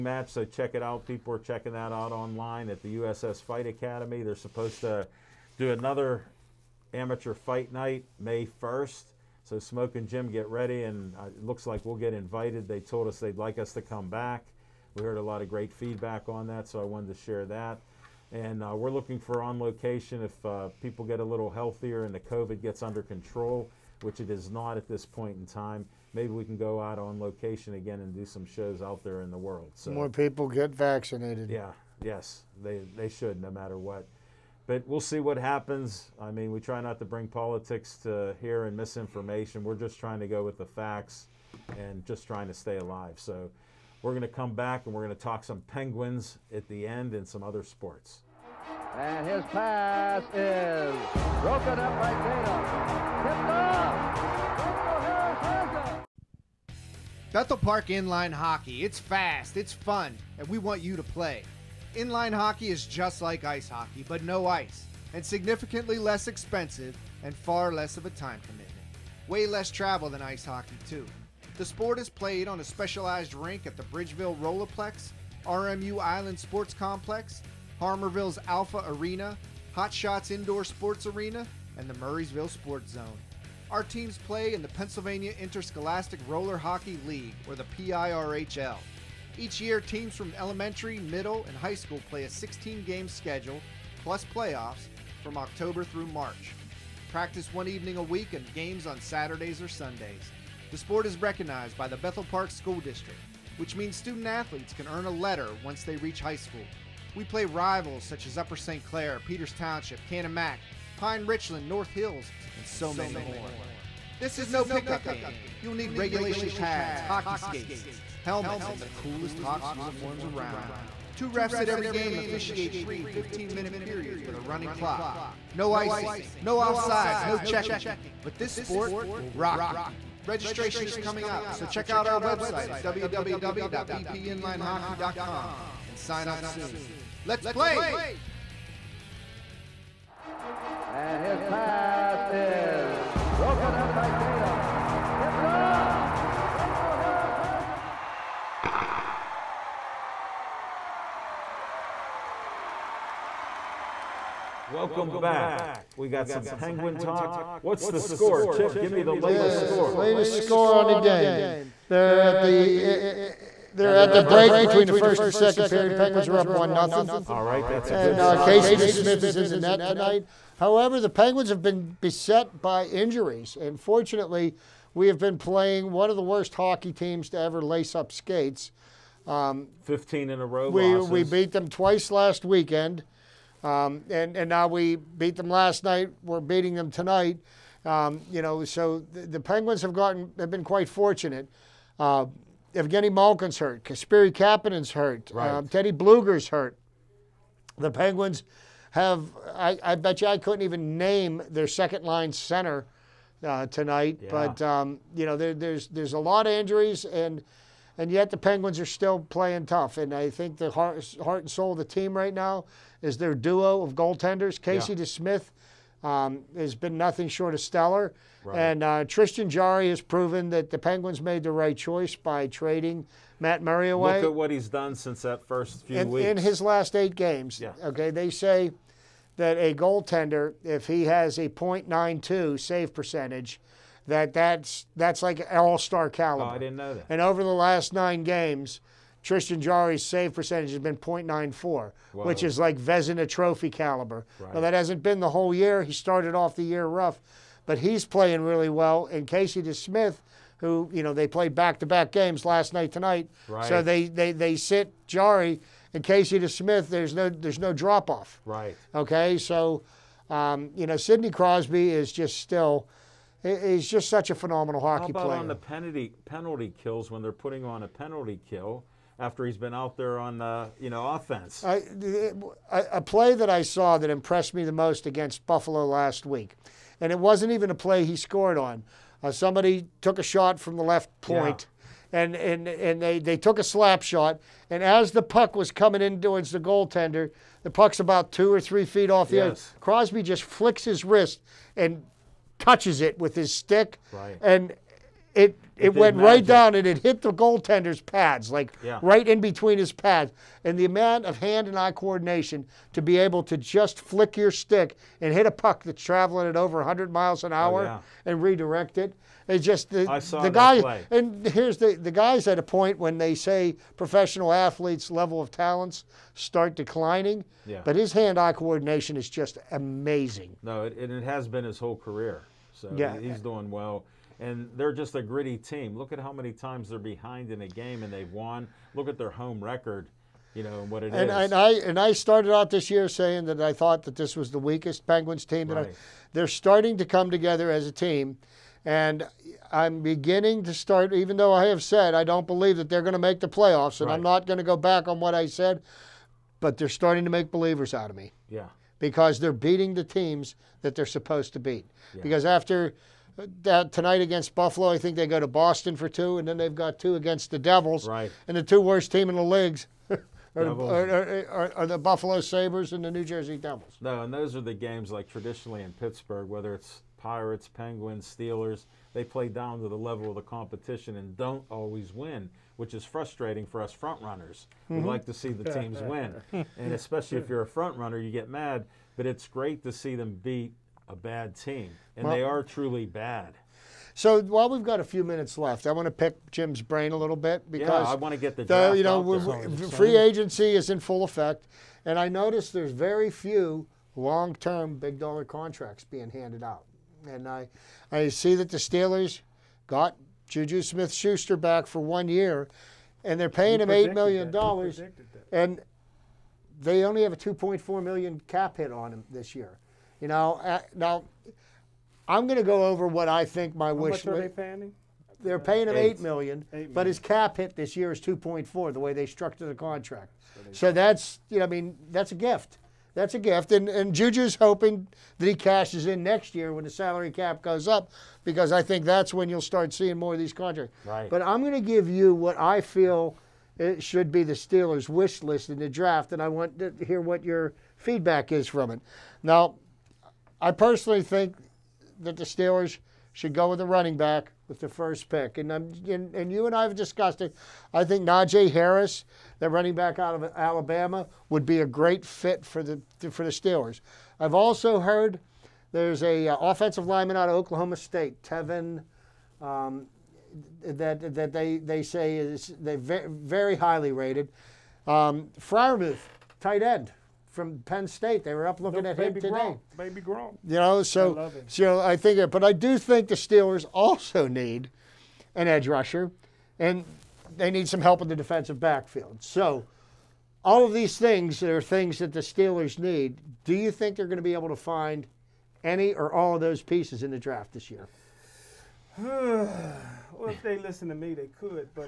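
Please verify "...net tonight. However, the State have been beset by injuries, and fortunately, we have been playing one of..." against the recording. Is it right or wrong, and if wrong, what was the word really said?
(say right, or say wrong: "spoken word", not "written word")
wrong: "Penguins", not "State".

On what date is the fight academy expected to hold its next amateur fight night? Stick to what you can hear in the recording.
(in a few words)
May 1st.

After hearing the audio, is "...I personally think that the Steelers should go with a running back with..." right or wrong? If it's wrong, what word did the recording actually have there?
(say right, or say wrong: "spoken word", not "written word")
right.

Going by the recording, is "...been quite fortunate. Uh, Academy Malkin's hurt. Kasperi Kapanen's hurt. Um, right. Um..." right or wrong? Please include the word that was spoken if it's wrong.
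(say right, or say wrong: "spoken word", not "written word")
wrong: "Evgeny", not "Academy".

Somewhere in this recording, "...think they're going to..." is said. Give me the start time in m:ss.
8:03.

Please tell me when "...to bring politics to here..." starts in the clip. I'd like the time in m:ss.
0:36.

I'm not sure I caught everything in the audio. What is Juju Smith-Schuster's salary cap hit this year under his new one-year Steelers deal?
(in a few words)
2.4 million.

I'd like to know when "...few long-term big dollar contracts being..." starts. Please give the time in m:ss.
6:33.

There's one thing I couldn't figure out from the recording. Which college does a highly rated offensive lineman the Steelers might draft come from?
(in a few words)
Oklahoma State.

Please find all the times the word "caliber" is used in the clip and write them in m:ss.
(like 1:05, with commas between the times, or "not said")
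3:56, 4:03.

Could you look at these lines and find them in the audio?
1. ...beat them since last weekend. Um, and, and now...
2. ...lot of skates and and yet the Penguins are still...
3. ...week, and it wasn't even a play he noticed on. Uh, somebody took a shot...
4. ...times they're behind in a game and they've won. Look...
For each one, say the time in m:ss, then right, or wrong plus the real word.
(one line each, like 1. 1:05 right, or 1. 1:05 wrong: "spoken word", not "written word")
1. 3:01 wrong: "twice", not "since"
2. 3:26 wrong: "injuries", not "skates"
3. 4:36 wrong: "scored", not "noticed"
4. 5:26 right.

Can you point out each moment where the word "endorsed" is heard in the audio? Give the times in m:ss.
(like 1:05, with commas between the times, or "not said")
not said.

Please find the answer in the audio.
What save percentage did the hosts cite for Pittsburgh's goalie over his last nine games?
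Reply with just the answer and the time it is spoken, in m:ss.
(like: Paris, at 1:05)
.94, at 4:00.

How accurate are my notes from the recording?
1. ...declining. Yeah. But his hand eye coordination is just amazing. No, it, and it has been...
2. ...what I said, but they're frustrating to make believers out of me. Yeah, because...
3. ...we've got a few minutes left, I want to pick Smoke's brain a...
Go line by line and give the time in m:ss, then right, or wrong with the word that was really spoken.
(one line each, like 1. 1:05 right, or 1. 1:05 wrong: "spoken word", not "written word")
1. 5:16 right
2. 5:45 wrong: "starting", not "frustrating"
3. 6:24 wrong: "Jim", not "Smoke".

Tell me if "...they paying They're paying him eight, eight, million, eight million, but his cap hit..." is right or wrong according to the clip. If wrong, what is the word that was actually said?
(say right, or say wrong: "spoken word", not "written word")
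right.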